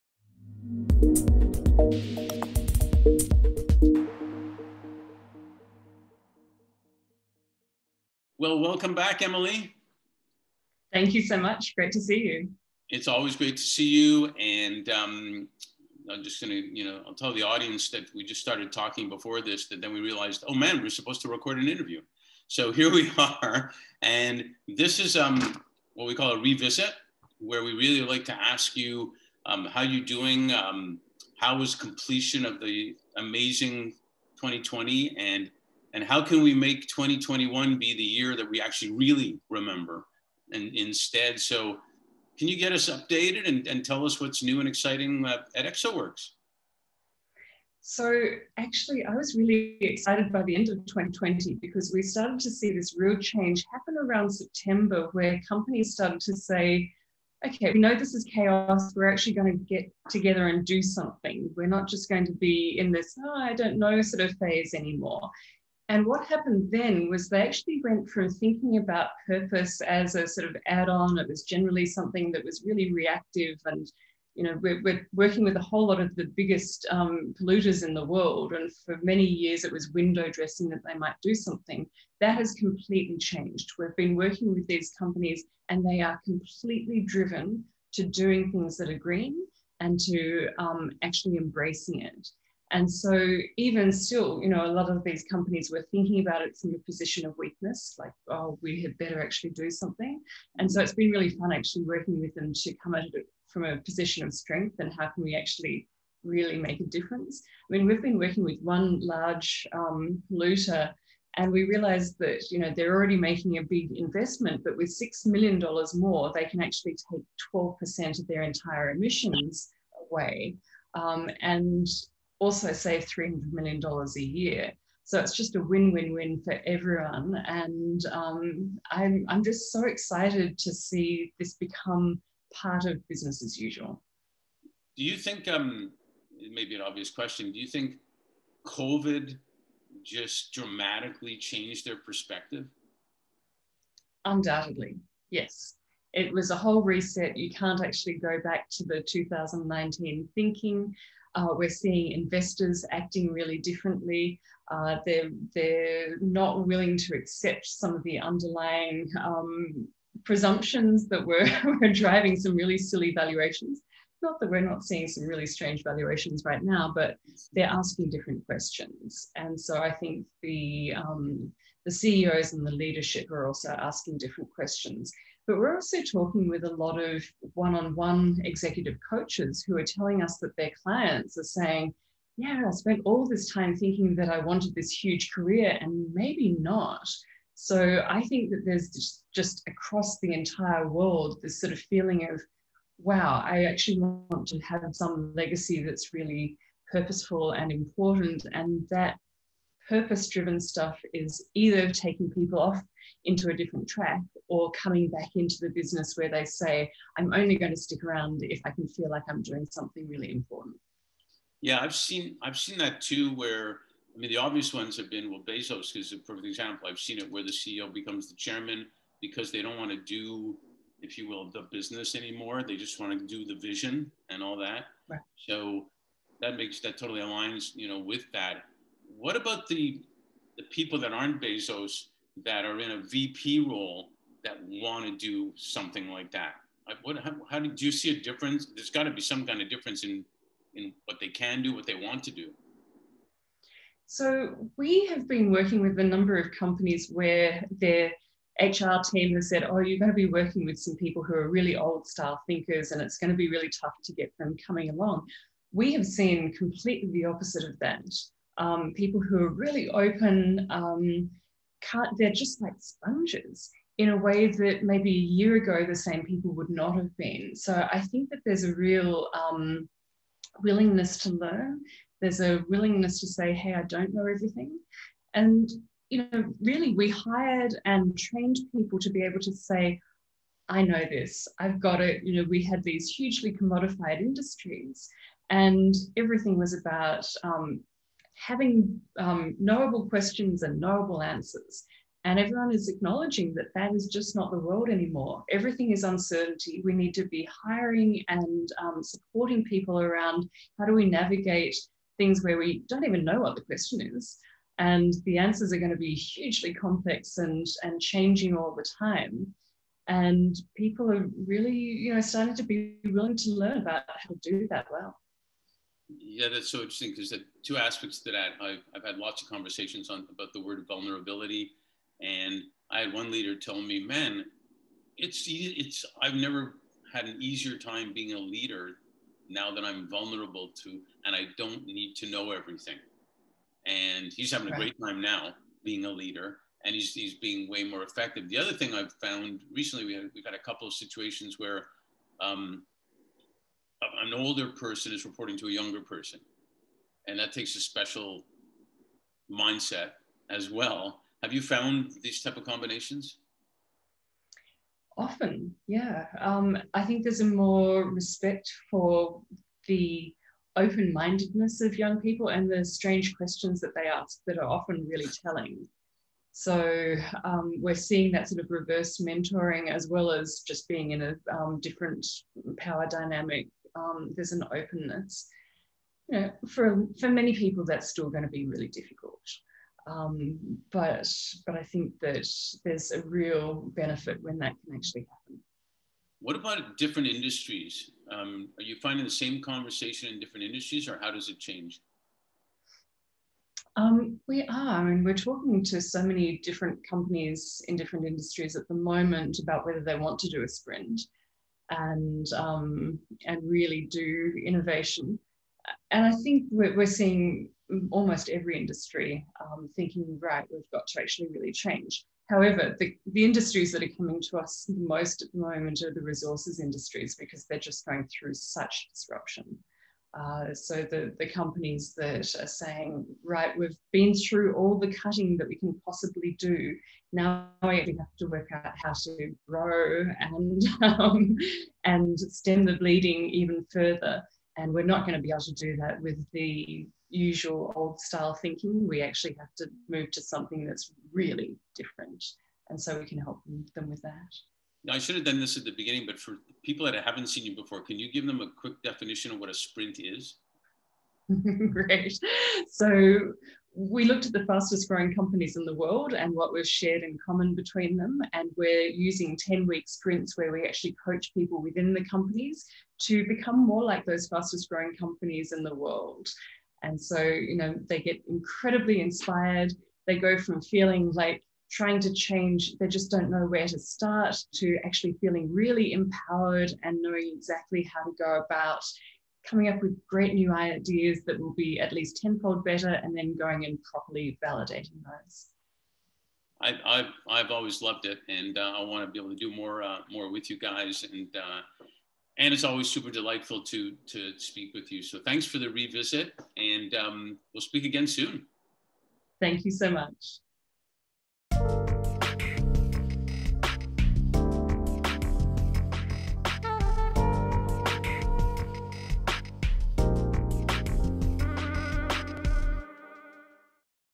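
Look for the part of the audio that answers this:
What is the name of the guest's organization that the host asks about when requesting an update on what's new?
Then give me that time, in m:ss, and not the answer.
0:45.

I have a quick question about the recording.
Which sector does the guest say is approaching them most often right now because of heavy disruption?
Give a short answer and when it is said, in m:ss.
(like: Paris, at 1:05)
resources industries, at 6:56.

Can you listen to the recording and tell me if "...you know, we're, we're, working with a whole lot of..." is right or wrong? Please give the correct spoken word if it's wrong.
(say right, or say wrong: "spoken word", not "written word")
right.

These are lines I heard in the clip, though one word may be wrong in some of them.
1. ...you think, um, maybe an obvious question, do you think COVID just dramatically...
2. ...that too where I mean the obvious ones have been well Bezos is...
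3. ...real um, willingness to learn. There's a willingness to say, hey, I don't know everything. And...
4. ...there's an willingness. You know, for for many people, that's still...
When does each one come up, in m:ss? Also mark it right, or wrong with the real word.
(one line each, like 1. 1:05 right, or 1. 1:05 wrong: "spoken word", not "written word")
1. 2:15 right
2. 3:32 right
3. 4:28 right
4. 6:14 wrong: "openness", not "willingness".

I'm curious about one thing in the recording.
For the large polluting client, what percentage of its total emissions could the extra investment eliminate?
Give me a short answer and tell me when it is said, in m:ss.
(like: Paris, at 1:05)
12%, at 1:57.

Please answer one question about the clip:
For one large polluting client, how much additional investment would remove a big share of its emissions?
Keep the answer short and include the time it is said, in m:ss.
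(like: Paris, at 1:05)
$6 million, at 1:54.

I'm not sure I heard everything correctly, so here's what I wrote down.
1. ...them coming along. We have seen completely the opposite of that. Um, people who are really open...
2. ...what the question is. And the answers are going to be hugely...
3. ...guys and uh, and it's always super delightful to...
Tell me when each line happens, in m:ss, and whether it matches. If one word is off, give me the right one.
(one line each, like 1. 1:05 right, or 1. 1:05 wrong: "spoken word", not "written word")
1. 4:14 right
2. 5:03 right
3. 8:10 right.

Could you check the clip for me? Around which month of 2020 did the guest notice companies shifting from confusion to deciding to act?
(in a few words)
September.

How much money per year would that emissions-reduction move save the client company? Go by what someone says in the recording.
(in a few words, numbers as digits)
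$300 million.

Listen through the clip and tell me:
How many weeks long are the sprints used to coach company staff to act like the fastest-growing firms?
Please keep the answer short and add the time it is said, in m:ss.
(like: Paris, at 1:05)
10, at 7:39.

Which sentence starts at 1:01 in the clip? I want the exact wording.
We're not just going to be in this, oh, I don't know sort of phase anymore.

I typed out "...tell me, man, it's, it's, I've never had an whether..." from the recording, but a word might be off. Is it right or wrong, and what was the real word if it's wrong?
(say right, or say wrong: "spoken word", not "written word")
wrong: "easier", not "whether".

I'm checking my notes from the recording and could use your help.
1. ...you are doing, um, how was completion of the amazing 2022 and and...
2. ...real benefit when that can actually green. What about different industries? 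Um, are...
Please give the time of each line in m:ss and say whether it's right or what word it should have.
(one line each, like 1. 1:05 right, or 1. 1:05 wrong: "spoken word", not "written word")
1. 0:29 wrong: "2020", not "2022"
2. 6:23 wrong: "happen", not "green".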